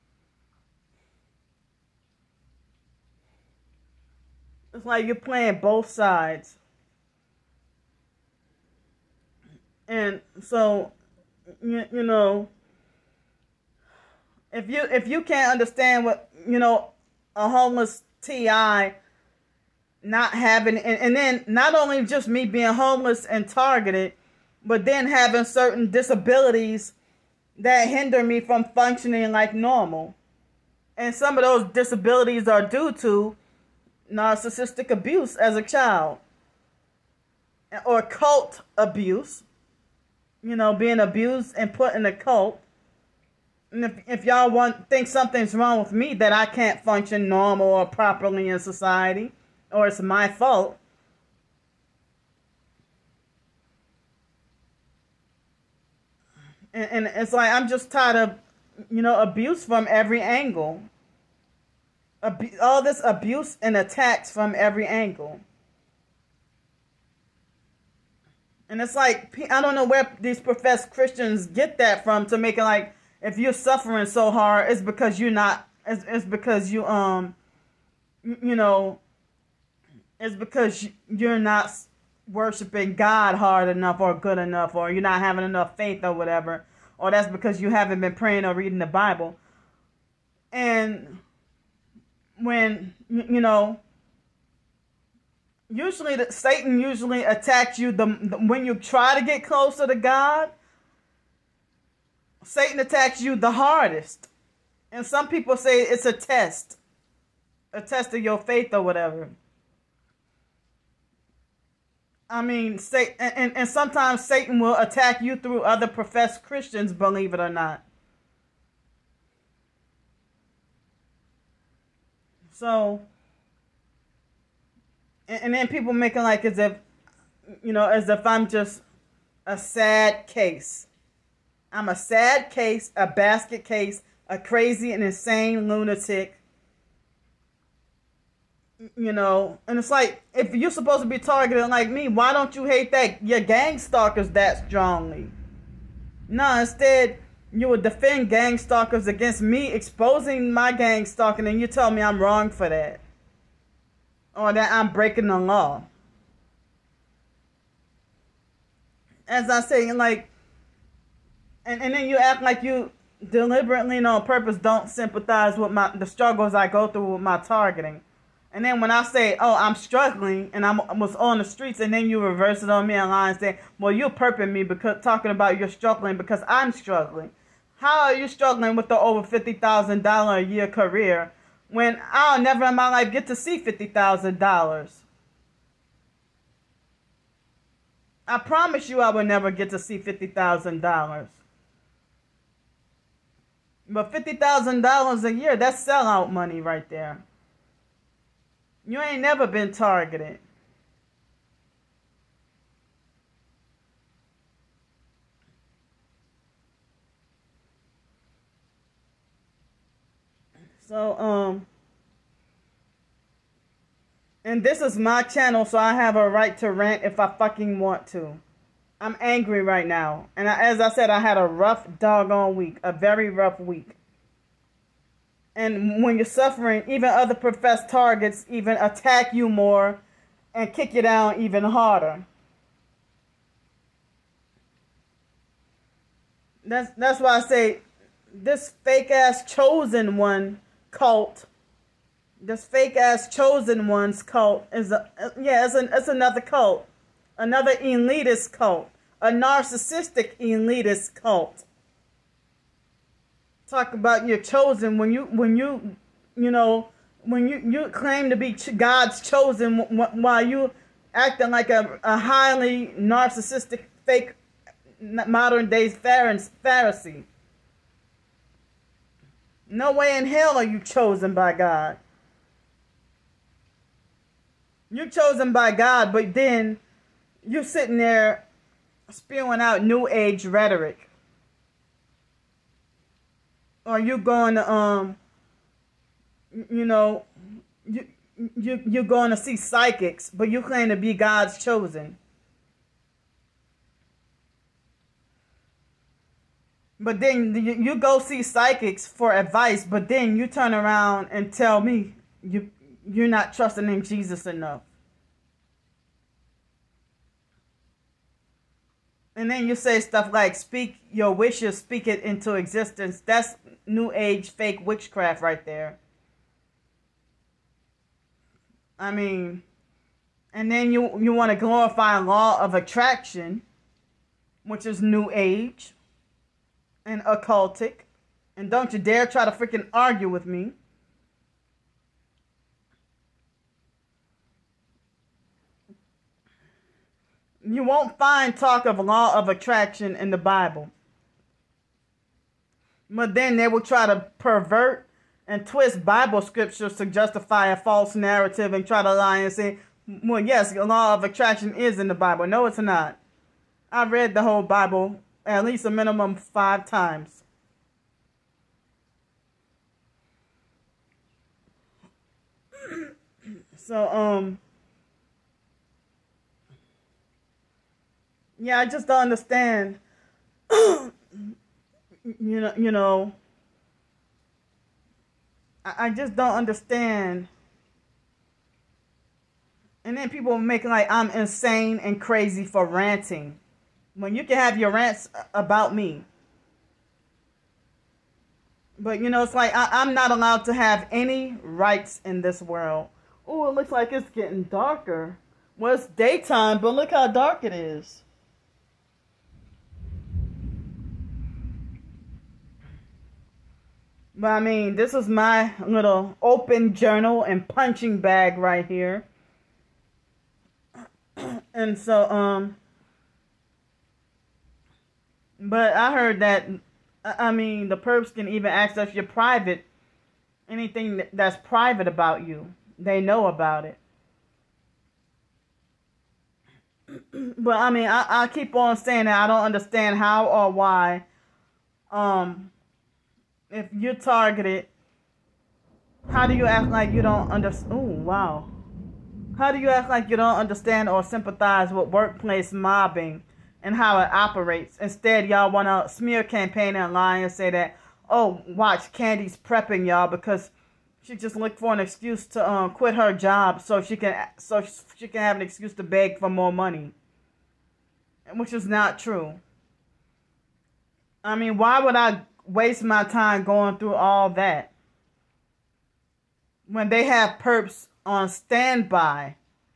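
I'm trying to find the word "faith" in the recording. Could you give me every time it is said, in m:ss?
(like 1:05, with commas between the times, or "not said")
1:25, 1:48.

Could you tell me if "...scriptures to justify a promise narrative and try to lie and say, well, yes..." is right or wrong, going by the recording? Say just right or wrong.
wrong.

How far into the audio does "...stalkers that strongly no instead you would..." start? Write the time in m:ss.
2:23.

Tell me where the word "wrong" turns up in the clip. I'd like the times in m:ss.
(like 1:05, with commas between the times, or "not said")
0:45, 2:32.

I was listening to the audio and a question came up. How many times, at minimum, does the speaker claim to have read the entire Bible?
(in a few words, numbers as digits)
5.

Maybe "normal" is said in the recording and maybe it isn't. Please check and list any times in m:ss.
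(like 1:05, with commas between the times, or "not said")
0:29, 0:47.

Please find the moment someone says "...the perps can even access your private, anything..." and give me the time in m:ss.
6:57.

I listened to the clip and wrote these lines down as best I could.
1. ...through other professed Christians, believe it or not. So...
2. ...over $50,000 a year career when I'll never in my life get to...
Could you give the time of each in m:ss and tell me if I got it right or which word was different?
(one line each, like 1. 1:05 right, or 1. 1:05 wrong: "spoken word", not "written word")
1. 1:55 right
2. 2:58 right.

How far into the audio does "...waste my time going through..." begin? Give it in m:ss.
7:42.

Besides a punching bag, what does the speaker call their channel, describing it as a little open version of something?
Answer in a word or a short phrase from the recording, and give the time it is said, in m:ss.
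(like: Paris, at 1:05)
open journal, at 6:46.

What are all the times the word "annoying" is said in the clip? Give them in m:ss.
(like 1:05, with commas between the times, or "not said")
not said.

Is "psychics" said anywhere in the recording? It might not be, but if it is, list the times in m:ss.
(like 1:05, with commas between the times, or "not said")
4:49, 4:58.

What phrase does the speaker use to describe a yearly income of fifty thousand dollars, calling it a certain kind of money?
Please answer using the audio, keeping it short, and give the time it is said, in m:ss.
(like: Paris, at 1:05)
sellout money, at 3:15.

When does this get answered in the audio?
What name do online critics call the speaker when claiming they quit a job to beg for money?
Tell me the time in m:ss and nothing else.
7:29.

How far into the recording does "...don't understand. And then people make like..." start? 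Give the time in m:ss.
6:16.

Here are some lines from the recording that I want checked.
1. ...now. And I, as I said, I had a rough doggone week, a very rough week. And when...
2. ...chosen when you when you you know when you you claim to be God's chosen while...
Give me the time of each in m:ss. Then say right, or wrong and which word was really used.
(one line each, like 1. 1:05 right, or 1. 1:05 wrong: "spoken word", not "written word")
1. 3:39 right
2. 4:14 right.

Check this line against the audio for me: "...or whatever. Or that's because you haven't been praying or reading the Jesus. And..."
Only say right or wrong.
wrong.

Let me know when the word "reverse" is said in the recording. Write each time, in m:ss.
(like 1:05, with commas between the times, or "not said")
2:52.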